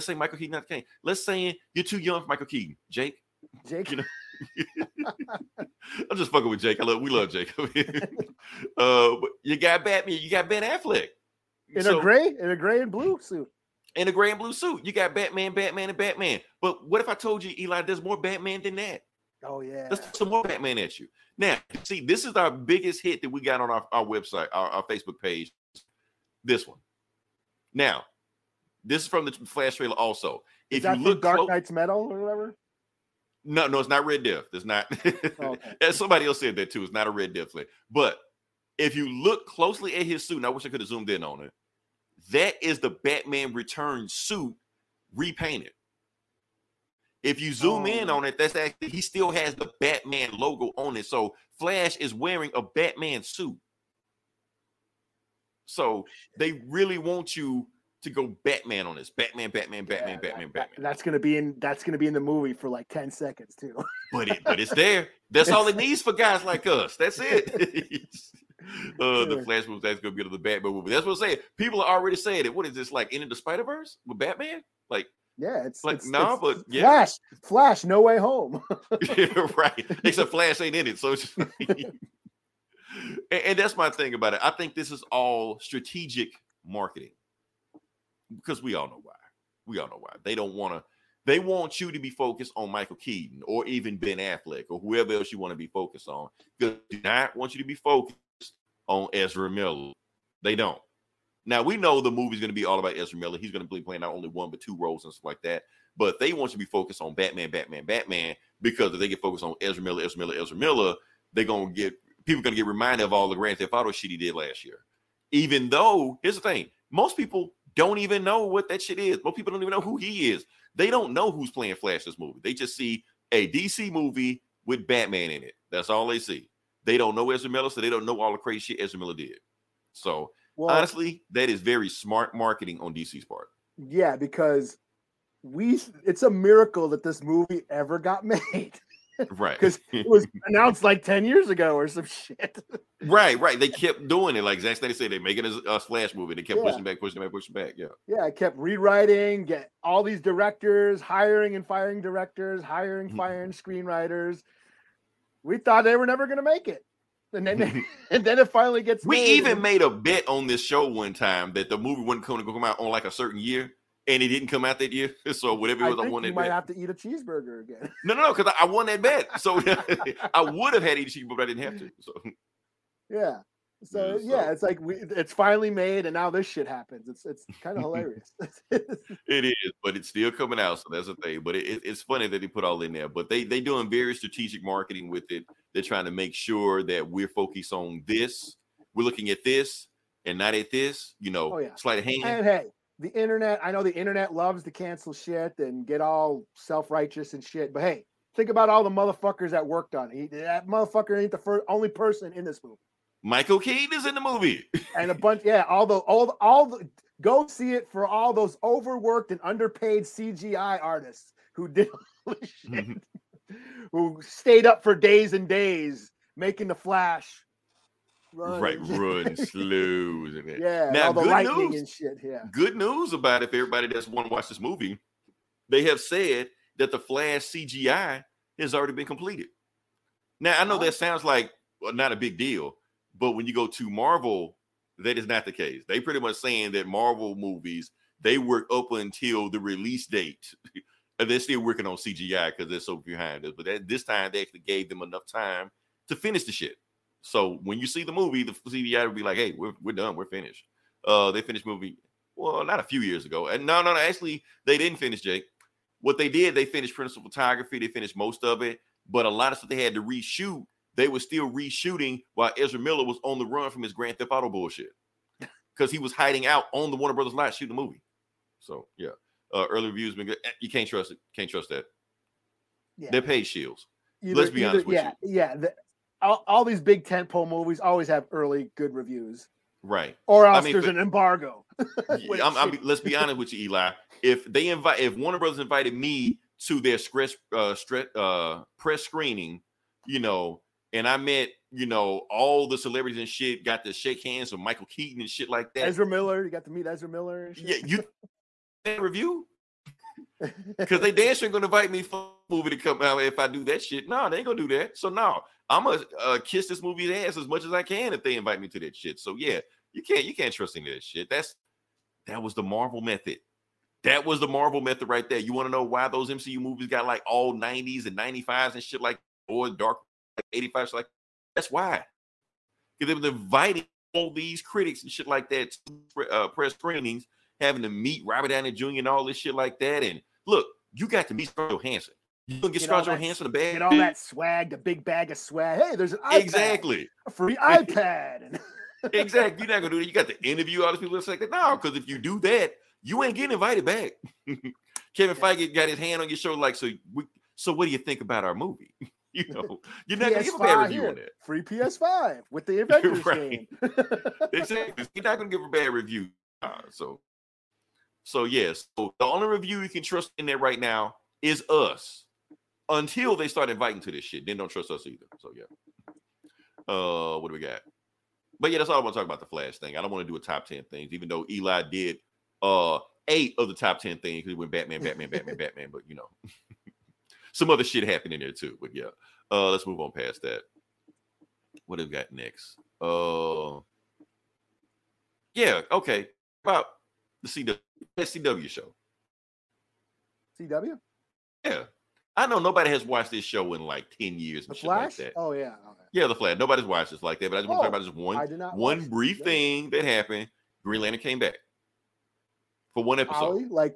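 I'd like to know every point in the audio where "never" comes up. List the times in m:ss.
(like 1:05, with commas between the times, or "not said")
2:36.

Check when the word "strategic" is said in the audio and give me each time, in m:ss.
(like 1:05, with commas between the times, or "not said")
1:25, 3:04.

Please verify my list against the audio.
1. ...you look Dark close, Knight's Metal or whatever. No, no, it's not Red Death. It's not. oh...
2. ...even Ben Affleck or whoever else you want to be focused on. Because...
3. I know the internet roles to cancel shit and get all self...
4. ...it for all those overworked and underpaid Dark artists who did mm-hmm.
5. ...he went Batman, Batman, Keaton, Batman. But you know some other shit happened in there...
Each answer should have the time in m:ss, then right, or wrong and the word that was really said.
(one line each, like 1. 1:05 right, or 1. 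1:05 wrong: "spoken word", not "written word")
1. 0:30 right
2. 1:33 right
3. 3:13 wrong: "loves", not "roles"
4. 3:27 wrong: "CGI", not "Dark"
5. 6:14 wrong: "Batman", not "Keaton".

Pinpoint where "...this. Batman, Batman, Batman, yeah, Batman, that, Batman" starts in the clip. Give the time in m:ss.
0:58.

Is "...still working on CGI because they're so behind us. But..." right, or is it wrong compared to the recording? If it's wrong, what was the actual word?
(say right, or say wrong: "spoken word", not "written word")
right.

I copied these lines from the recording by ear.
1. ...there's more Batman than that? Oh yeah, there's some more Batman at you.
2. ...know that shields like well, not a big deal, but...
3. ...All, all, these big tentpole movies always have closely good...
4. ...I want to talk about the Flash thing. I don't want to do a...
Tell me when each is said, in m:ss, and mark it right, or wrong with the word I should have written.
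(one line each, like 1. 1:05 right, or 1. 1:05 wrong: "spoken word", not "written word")
1. 0:17 right
2. 3:50 wrong: "sounds", not "shields"
3. 4:36 wrong: "early", not "closely"
4. 6:08 right.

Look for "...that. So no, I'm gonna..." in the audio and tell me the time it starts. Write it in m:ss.
5:04.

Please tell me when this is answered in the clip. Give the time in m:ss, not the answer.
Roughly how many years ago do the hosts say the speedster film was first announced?
2:21.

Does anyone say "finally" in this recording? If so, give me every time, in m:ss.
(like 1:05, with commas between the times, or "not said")
2:38, 2:55.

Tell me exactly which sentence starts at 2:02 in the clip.
They just see a DC movie with Batman in it.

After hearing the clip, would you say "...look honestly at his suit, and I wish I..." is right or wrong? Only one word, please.
wrong.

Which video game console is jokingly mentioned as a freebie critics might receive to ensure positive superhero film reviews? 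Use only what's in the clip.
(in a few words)
PS5.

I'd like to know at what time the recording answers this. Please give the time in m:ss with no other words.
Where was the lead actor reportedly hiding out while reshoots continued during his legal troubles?
4:26.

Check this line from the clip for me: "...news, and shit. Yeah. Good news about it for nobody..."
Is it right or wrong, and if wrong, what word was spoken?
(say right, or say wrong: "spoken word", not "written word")
wrong: "everybody", not "nobody".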